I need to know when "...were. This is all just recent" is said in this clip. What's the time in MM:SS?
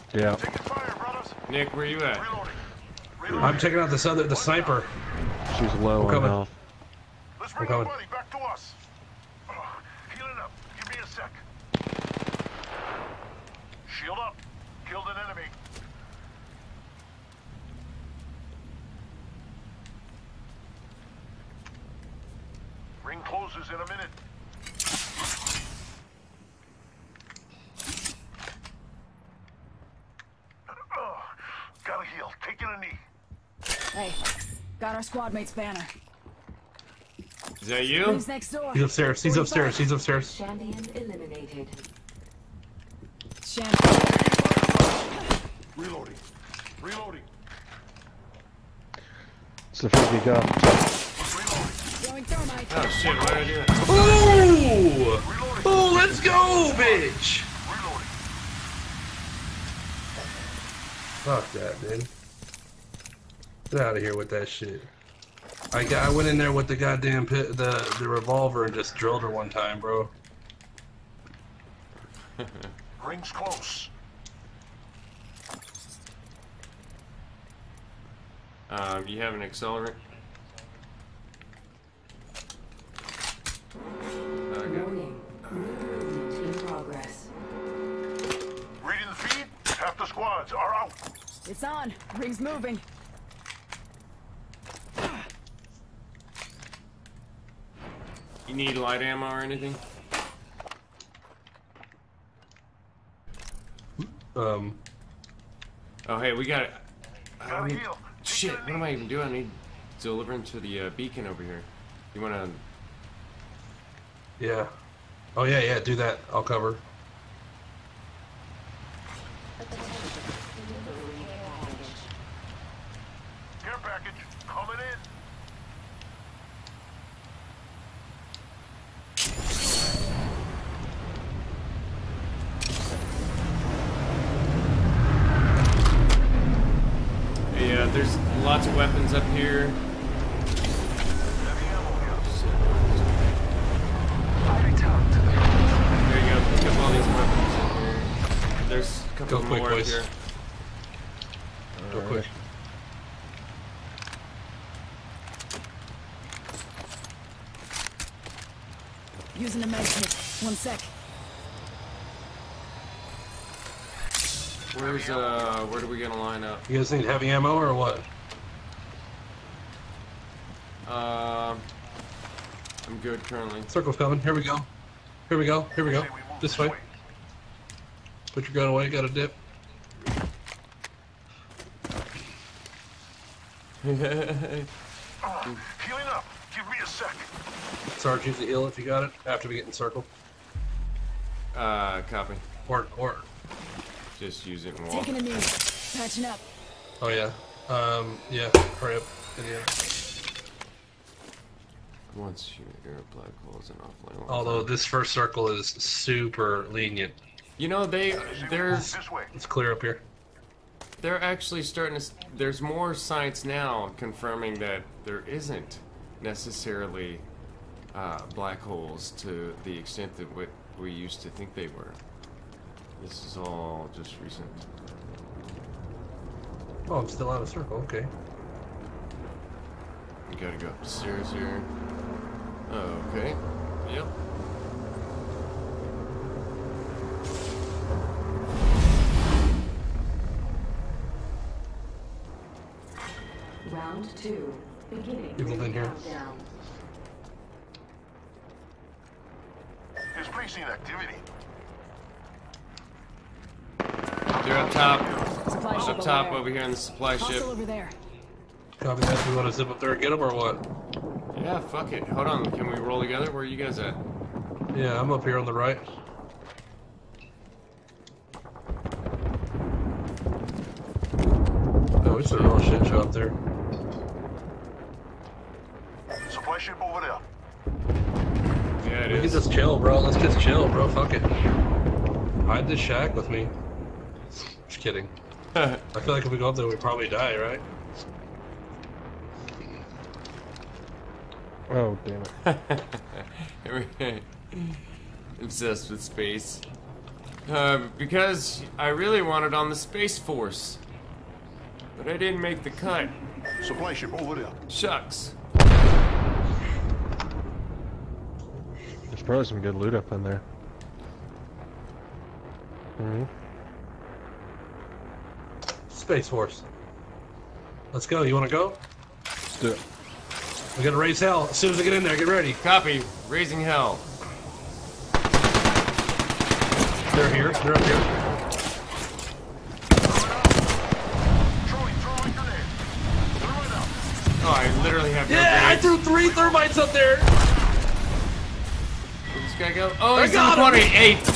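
03:41.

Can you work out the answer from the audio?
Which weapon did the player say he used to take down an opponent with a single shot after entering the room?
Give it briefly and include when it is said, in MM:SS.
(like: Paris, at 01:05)
Revolver, at 01:07.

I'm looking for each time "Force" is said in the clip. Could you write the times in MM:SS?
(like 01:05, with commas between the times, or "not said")
05:00, 05:16.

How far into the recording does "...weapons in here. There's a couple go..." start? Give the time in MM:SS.
02:27.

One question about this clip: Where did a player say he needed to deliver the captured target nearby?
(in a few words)
Beacon.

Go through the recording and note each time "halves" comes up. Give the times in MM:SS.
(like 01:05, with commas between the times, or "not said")
not said.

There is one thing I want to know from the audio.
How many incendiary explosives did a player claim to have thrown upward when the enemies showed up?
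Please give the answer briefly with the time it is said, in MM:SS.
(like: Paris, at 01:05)
3 thermites, at 05:35.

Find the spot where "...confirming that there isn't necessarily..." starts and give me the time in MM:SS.
03:33.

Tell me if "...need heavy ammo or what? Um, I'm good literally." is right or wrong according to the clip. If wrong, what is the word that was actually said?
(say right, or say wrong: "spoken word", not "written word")
wrong: "currently", not "literally".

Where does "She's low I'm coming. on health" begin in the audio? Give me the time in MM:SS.
00:05.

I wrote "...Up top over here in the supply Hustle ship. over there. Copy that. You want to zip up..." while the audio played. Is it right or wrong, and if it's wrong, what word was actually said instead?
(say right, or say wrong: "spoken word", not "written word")
right.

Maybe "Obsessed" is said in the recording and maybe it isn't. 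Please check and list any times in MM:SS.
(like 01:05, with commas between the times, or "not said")
04:55.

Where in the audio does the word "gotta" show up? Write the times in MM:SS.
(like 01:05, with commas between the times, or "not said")
03:50, 05:20.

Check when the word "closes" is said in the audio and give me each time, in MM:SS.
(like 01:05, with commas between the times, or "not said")
00:23, 01:13.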